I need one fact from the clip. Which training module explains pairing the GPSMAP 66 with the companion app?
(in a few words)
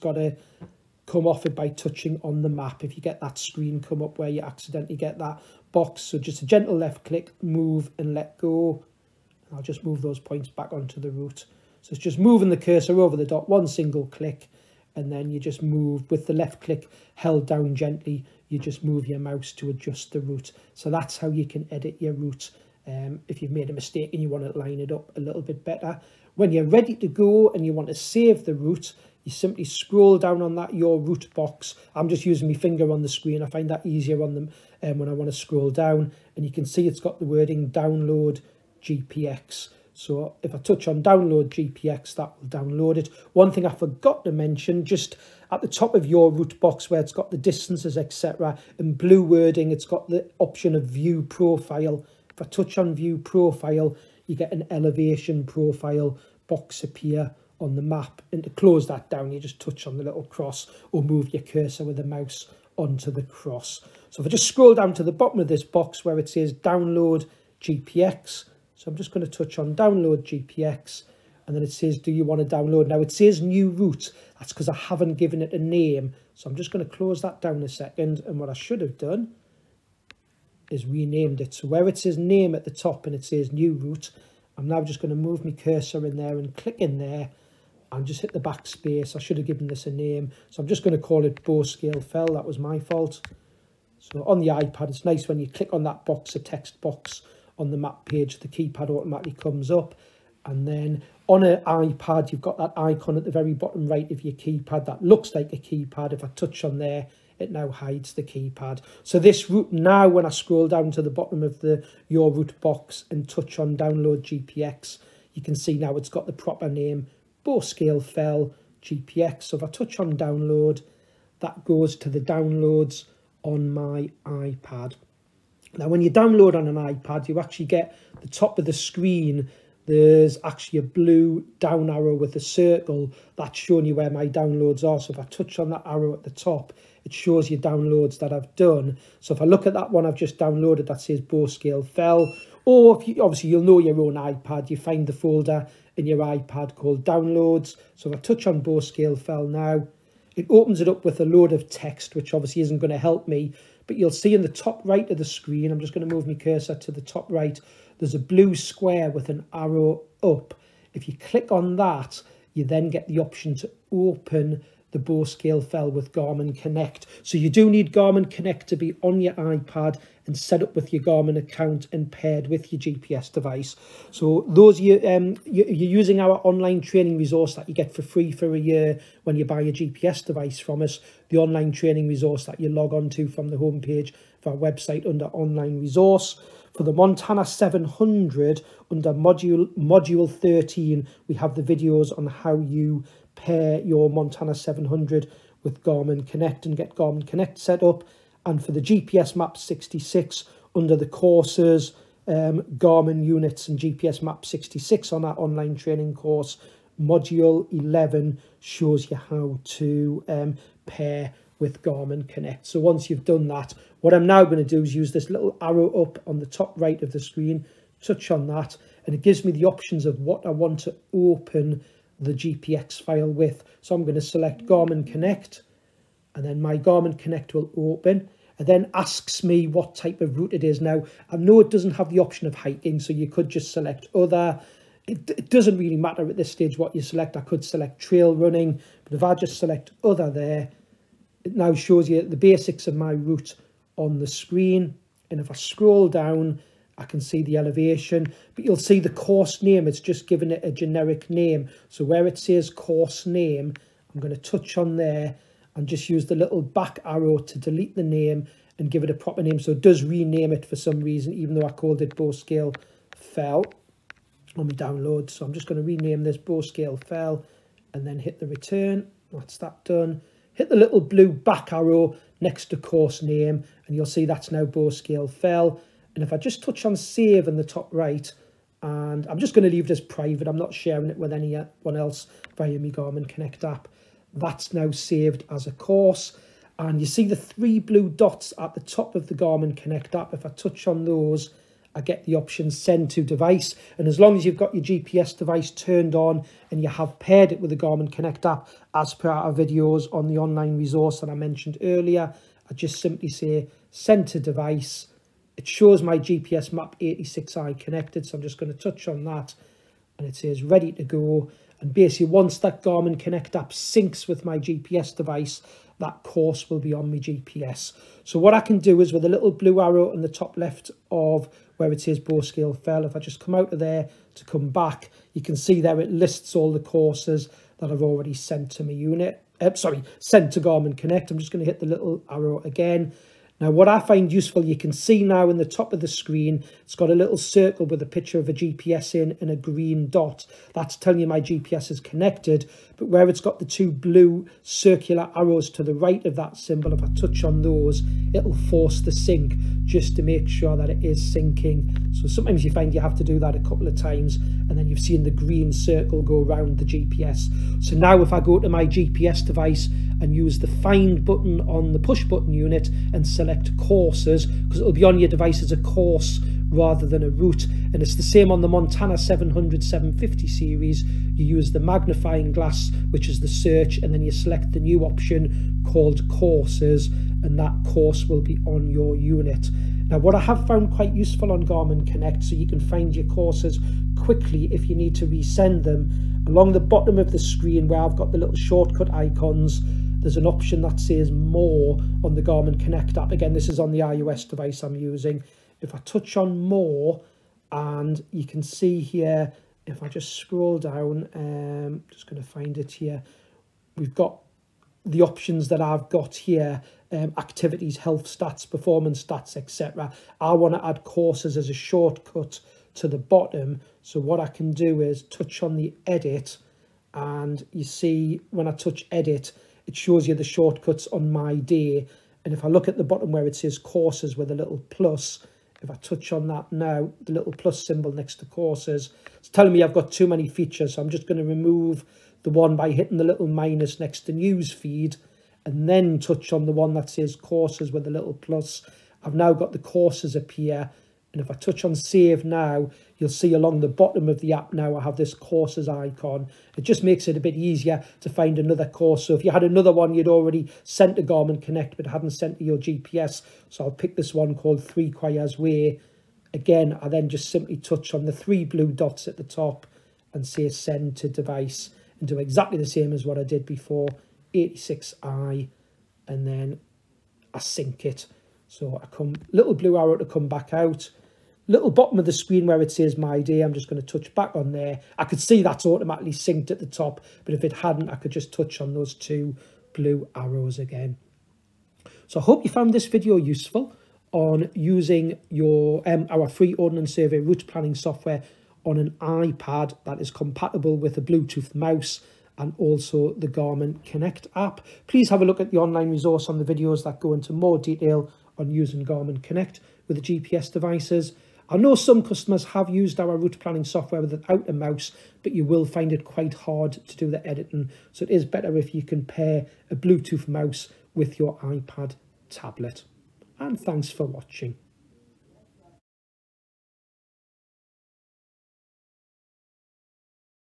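Module 11.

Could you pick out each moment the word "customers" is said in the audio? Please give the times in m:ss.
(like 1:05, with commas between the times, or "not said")
8:22.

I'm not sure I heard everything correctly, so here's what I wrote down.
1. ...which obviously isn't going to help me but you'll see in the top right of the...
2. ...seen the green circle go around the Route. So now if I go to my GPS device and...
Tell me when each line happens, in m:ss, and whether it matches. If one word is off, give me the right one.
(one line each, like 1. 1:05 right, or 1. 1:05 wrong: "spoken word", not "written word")
1. 2:32 right
2. 5:54 wrong: "GPS", not "Route".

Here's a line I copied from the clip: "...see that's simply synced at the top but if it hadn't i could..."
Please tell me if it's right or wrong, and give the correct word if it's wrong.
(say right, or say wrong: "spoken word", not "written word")
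wrong: "automatically", not "simply".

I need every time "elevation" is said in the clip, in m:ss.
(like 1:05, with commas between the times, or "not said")
0:54, 4:07.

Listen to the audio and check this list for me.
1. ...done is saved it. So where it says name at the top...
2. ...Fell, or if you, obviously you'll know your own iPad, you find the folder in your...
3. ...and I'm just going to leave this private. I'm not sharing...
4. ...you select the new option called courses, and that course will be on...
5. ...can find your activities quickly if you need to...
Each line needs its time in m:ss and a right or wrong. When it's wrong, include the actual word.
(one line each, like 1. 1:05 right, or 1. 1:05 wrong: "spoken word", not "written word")
1. 1:18 wrong: "renamed", not "saved"
2. 2:21 right
3. 4:38 right
4. 6:14 right
5. 6:22 wrong: "courses", not "activities".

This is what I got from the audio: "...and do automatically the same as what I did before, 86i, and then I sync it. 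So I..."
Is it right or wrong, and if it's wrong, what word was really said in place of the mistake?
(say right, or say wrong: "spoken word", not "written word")
wrong: "exactly", not "automatically".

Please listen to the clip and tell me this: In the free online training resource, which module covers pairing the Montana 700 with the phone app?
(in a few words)
Module 13.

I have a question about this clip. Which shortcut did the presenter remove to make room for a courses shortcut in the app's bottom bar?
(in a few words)
News feed.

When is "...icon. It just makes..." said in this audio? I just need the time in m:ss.
7:25.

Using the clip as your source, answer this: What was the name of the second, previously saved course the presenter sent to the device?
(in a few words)
Three Choirs Way.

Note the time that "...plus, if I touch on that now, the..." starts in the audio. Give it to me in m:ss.
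7:04.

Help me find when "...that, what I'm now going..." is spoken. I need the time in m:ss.
3:33.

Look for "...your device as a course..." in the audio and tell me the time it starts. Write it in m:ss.
6:05.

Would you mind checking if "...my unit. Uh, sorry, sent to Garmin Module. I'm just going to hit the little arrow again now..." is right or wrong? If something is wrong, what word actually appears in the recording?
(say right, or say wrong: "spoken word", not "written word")
wrong: "Connect", not "Module".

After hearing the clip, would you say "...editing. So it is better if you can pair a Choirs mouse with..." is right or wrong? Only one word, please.
wrong.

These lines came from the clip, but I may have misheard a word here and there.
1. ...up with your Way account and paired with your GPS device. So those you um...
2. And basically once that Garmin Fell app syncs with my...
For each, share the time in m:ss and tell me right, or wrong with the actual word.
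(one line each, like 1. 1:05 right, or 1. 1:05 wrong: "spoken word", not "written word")
1. 2:50 wrong: "Garmin", not "Way"
2. 5:11 wrong: "Connect", not "Fell".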